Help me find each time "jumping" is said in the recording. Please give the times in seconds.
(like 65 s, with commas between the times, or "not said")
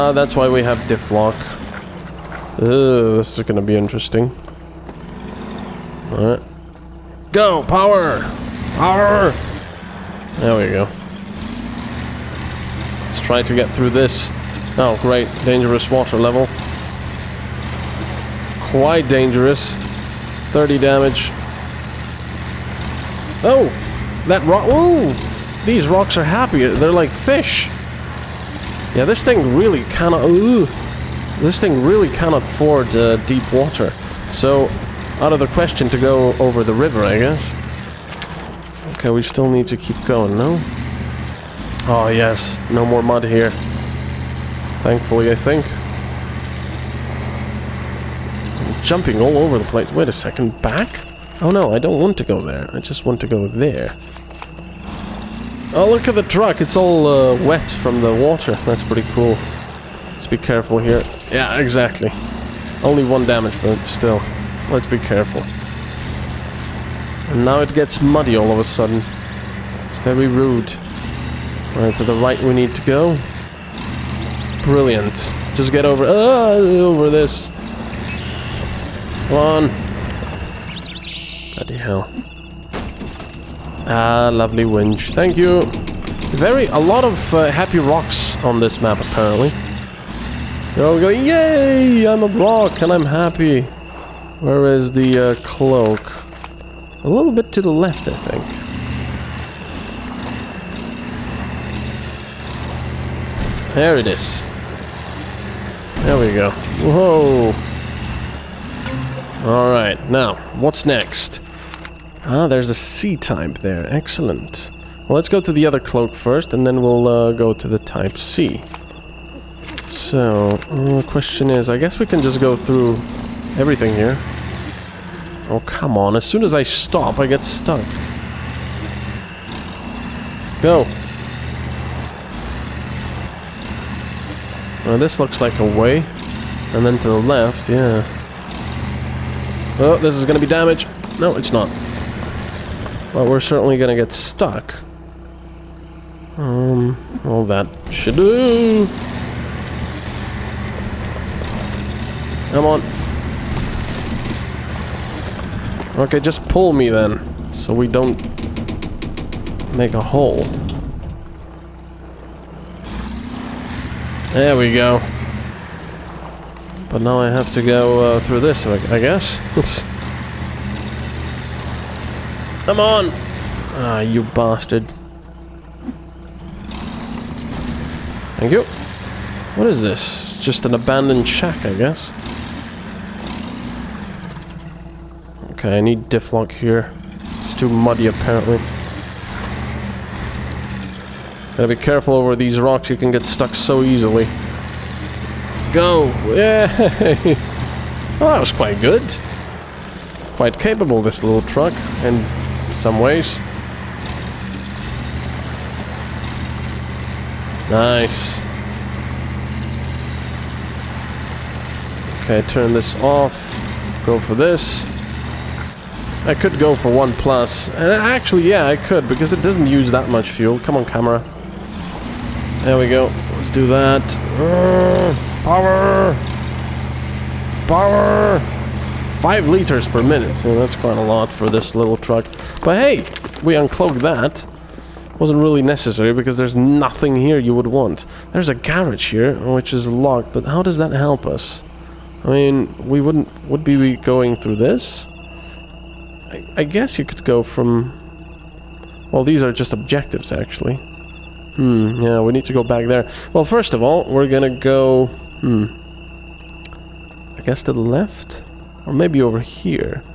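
48 s.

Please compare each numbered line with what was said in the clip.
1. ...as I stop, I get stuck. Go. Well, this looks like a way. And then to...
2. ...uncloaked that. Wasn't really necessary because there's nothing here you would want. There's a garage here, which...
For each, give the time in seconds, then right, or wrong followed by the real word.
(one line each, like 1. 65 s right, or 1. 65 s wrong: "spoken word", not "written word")
1. 126 s right
2. 233 s right.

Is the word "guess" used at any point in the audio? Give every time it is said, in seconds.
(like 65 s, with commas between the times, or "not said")
37 s, 121 s, 168 s, 181 s, 246 s, 257 s.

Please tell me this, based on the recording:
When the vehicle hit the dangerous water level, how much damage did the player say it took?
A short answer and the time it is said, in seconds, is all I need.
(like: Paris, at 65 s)
30, at 20 s.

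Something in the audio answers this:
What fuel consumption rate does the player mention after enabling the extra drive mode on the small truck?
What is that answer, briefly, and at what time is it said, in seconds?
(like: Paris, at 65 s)
5 liters per minute, at 229 s.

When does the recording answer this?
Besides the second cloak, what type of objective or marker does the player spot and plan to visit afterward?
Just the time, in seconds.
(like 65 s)
112 s.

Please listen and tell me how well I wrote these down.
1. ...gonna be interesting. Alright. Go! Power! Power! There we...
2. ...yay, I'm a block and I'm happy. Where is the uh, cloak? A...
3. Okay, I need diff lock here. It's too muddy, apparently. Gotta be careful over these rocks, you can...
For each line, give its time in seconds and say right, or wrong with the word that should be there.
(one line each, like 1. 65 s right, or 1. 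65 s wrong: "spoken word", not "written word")
1. 3 s right
2. 91 s right
3. 185 s right.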